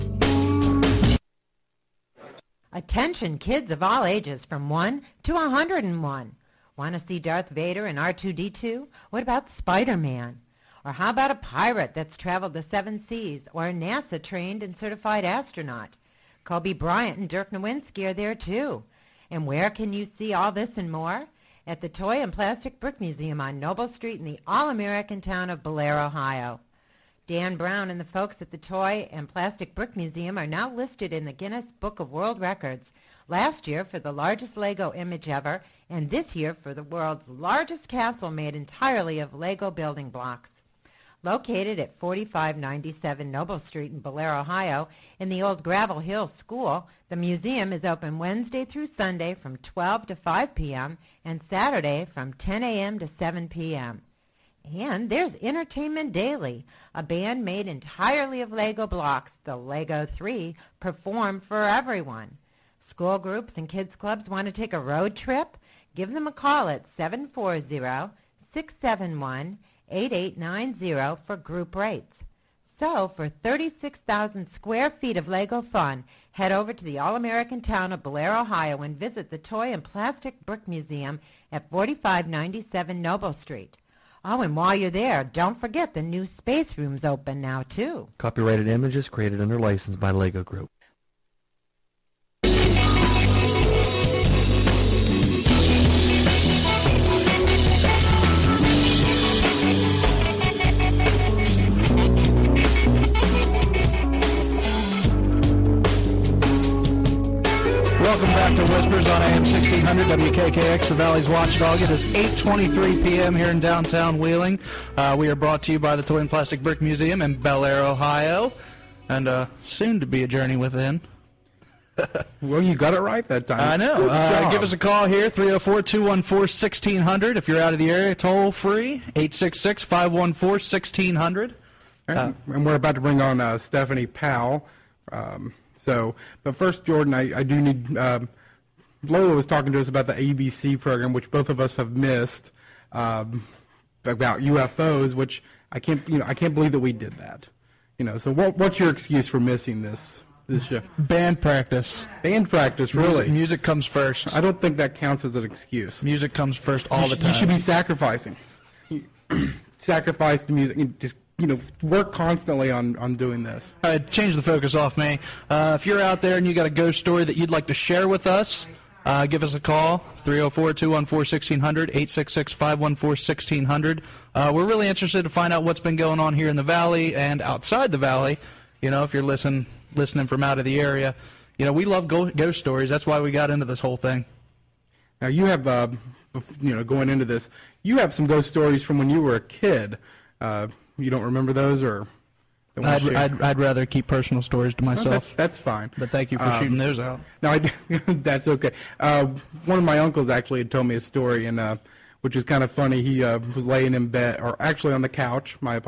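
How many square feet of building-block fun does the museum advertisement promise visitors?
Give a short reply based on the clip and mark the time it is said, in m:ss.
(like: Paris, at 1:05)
36,000, at 1:13.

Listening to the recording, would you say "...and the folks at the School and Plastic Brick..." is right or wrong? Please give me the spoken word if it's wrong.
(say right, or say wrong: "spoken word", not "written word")
wrong: "Toy", not "School".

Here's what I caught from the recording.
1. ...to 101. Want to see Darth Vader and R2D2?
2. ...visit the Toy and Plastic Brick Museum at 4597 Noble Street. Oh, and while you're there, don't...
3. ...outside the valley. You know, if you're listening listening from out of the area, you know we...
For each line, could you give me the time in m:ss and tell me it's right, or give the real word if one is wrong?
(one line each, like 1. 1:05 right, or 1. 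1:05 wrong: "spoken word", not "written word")
1. 0:05 right
2. 1:18 right
3. 2:57 right.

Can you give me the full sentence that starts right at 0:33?
Last year for the largest Lego image ever, and this year for the world's largest castle made entirely of Lego building blocks.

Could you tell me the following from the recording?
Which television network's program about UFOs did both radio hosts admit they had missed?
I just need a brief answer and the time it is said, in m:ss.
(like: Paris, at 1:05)
ABC, at 2:20.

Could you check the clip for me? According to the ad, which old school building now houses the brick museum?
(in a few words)
Gravel Hill School.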